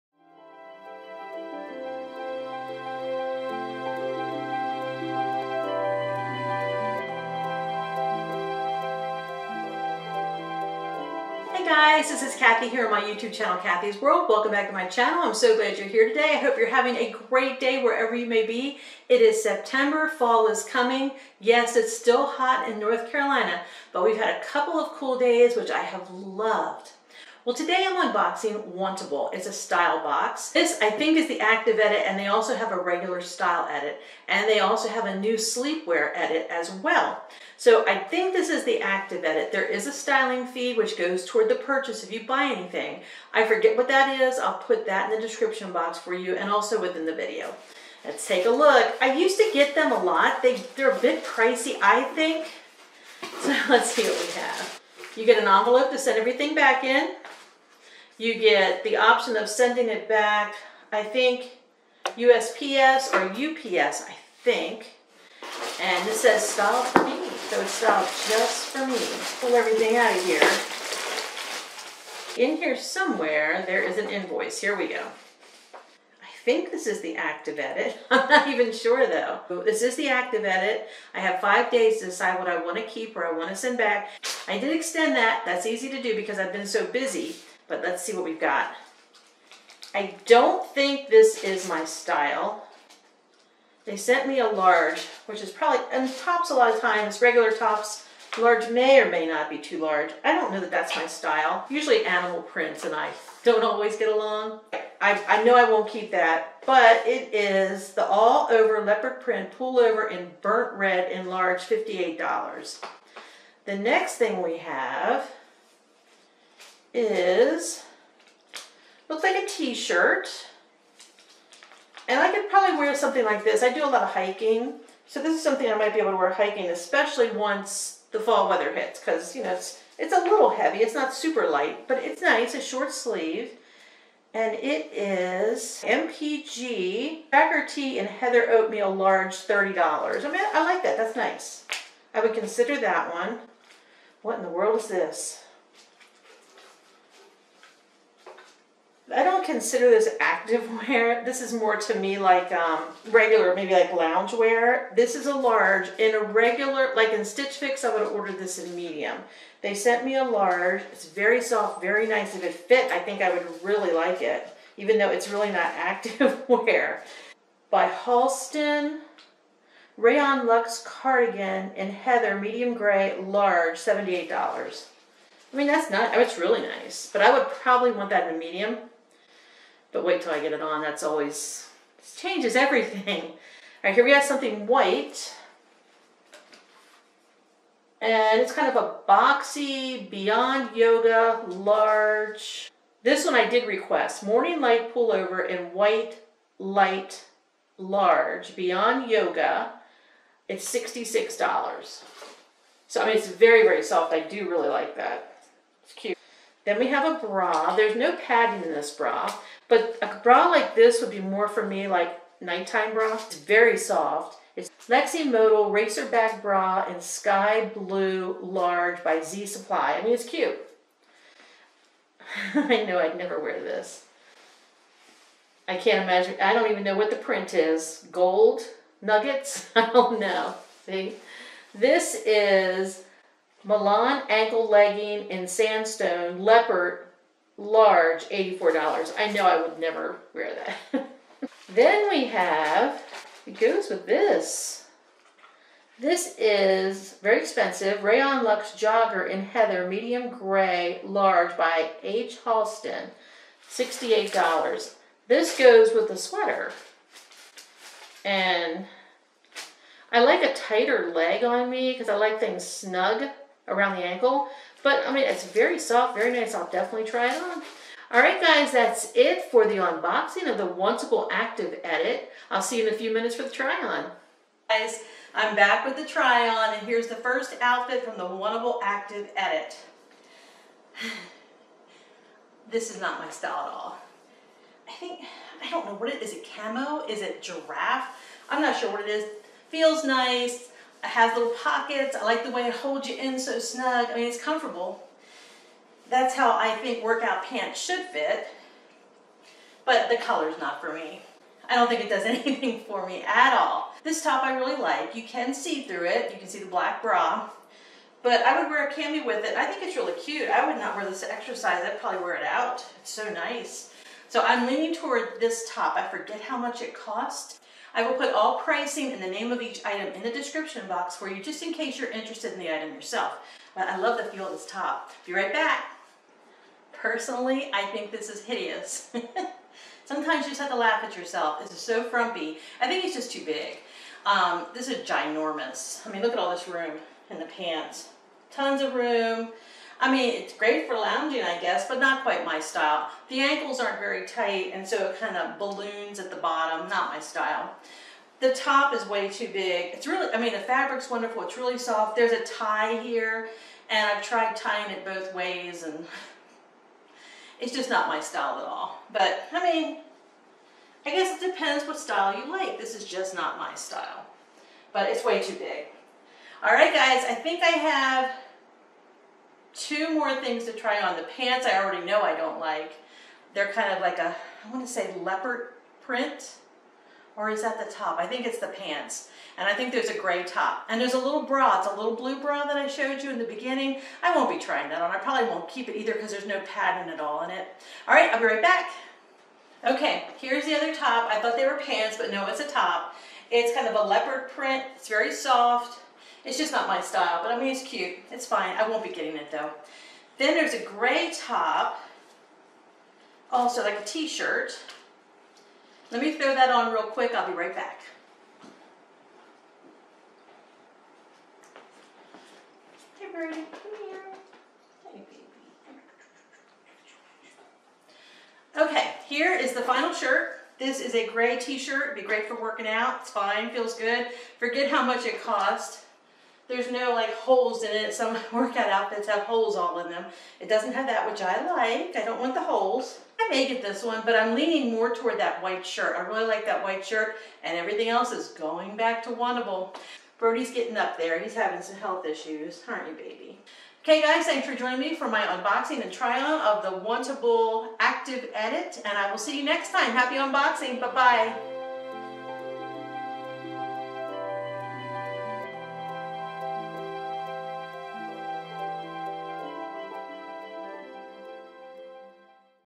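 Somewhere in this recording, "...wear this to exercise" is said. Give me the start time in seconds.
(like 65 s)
310 s.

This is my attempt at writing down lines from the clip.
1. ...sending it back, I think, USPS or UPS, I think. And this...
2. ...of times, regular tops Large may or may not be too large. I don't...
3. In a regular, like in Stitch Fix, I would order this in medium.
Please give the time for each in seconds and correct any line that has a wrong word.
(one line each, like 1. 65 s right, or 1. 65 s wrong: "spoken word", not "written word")
1. 59 s right
2. 96 s right
3. 155 s right.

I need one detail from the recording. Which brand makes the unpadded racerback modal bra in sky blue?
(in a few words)
Z Supply.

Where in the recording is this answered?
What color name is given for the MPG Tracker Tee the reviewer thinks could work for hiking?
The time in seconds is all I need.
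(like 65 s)
138 s.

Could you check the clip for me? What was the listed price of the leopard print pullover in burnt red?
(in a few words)
$58.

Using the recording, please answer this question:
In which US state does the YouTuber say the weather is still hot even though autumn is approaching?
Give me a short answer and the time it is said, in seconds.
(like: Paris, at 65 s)
North Carolina, at 22 s.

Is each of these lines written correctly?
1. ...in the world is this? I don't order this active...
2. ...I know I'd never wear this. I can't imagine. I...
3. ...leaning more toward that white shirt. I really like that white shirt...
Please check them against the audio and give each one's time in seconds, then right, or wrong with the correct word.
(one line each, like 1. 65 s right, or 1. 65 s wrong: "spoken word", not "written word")
1. 144 s wrong: "consider", not "order"
2. 222 s right
3. 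434 s right.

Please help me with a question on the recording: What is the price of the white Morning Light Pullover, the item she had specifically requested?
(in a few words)
$66.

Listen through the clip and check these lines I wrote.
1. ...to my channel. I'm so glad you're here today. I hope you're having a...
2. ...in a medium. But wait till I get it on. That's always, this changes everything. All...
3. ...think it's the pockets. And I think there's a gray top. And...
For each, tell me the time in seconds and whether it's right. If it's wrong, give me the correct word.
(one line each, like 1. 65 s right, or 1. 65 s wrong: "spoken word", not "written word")
1. 14 s right
2. 178 s right
3. 378 s wrong: "pants", not "pockets".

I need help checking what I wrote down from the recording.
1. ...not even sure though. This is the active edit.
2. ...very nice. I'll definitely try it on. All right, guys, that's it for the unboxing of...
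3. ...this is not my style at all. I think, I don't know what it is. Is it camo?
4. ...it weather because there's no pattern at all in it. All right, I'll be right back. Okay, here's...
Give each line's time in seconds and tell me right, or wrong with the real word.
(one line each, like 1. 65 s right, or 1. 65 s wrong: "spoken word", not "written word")
1. 78 s right
2. 266 s right
3. 282 s right
4. 385 s wrong: "either", not "weather".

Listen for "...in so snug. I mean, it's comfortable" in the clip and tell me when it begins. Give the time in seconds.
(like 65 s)
293 s.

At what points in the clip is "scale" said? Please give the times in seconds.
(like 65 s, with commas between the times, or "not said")
not said.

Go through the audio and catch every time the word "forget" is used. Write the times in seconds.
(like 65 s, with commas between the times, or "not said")
43 s, 316 s, 424 s.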